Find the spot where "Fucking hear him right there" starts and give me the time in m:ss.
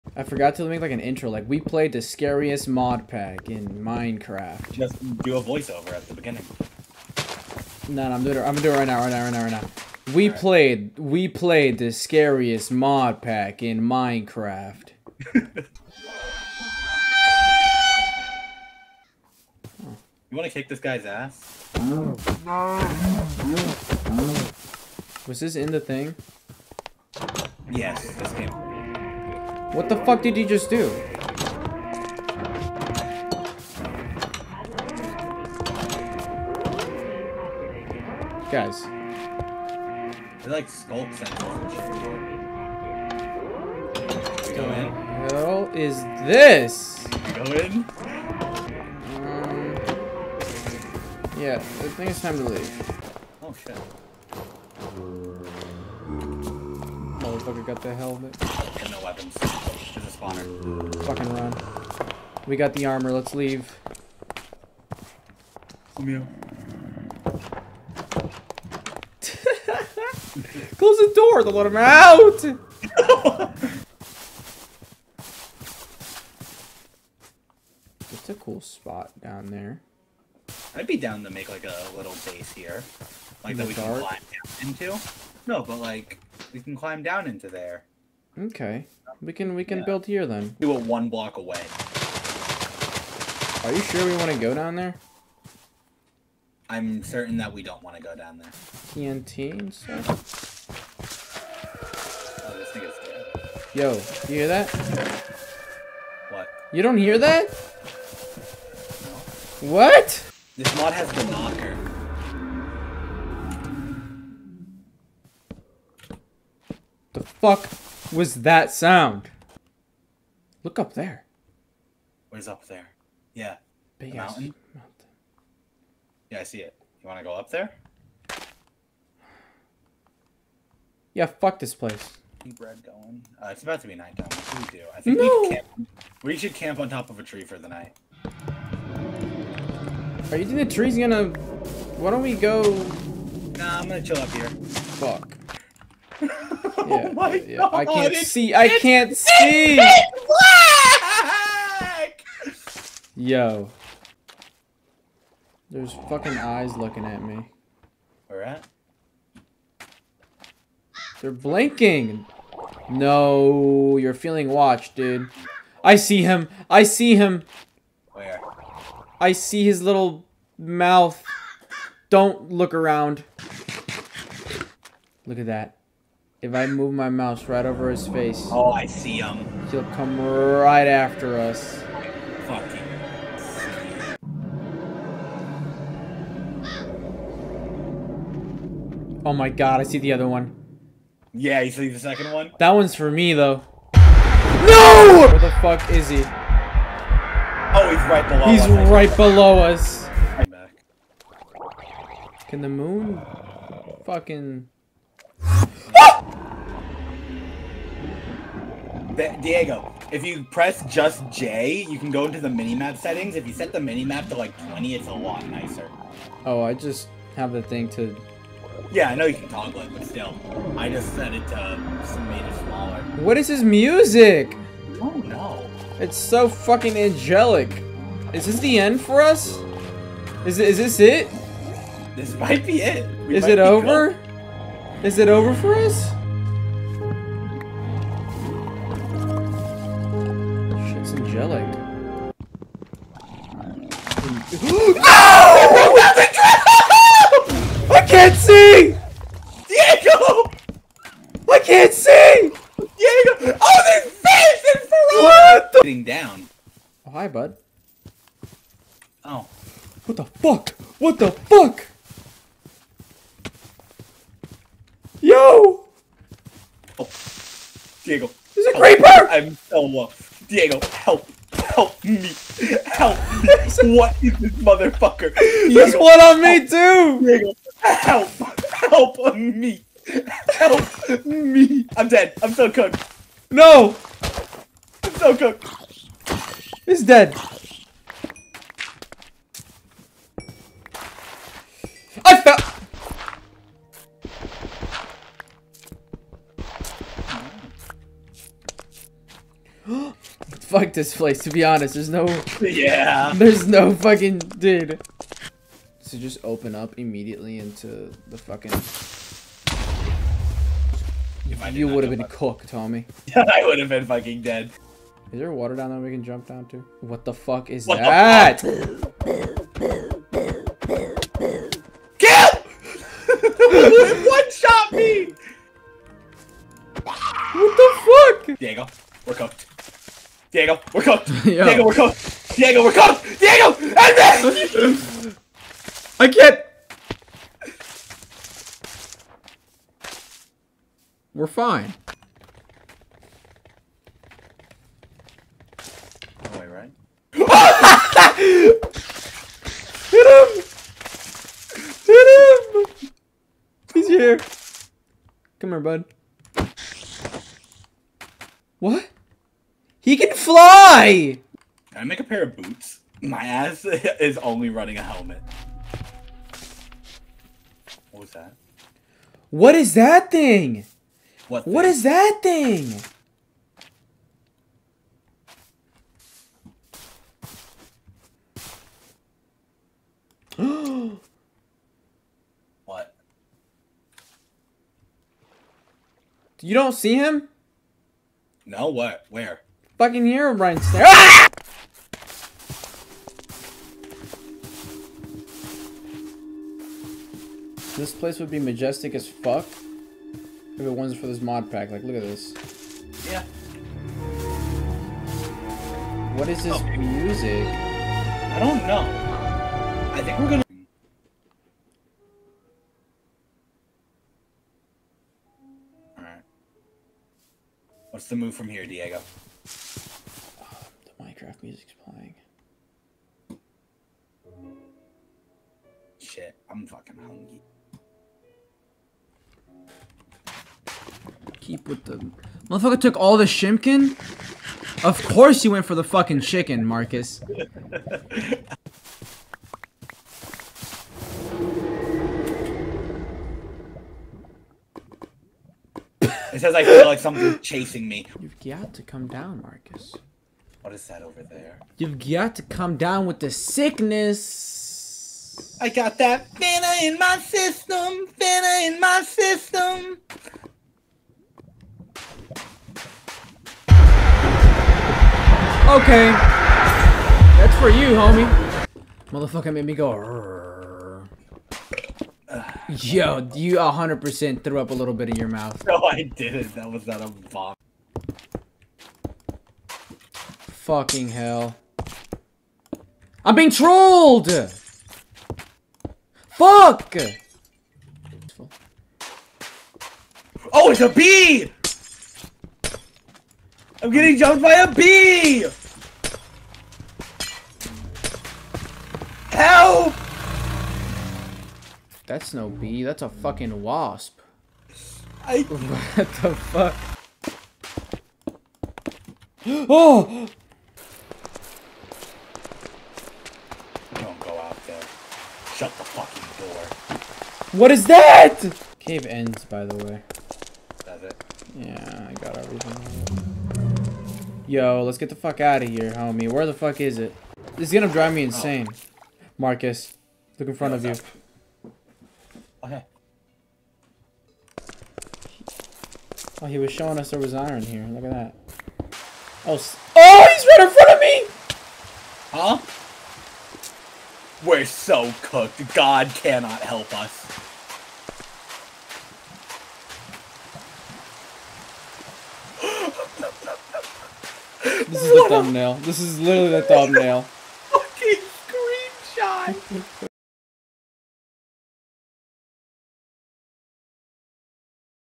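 6:30.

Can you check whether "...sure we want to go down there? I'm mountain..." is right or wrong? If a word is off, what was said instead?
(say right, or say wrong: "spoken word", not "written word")
wrong: "certain", not "mountain".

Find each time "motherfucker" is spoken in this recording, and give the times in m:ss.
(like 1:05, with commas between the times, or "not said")
0:57, 4:34, 7:12, 7:49.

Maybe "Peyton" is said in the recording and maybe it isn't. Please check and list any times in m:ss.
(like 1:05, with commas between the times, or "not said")
not said.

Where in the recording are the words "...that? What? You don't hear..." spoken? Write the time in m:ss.
1:44.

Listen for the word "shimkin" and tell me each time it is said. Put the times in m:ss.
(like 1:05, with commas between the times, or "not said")
7:13.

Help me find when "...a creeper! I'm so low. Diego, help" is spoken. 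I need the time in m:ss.
4:28.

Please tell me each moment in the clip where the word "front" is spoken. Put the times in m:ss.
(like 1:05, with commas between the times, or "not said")
8:50, 9:00.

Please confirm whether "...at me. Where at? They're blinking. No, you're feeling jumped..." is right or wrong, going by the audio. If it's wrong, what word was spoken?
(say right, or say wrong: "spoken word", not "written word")
wrong: "watched", not "jumped".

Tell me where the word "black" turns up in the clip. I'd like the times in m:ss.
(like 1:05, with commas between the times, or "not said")
2:31.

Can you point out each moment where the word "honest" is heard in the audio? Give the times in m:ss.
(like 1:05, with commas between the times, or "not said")
5:01.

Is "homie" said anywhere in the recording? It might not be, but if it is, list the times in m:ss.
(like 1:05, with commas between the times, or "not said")
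7:48, 8:46.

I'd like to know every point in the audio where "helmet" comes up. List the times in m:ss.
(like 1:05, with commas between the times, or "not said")
0:57, 6:05.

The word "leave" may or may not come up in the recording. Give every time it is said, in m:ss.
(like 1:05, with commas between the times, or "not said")
0:52, 1:03.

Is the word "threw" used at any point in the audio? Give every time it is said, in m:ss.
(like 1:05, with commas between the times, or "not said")
7:54.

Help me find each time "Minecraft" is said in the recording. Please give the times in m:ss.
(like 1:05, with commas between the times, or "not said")
0:03, 0:13.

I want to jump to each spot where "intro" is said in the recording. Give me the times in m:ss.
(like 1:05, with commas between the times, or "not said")
0:00.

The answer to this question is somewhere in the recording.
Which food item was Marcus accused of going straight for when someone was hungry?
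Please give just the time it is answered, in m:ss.
7:16.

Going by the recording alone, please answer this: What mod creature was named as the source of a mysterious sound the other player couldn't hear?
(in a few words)
The knocker.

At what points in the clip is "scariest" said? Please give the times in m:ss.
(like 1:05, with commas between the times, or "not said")
0:02, 0:11.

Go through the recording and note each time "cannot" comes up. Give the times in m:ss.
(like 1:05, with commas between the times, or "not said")
9:06.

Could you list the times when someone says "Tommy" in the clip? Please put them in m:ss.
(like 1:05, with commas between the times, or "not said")
5:12.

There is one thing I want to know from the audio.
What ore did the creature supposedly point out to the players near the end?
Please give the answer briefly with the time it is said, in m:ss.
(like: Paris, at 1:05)
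Iron, at 8:57.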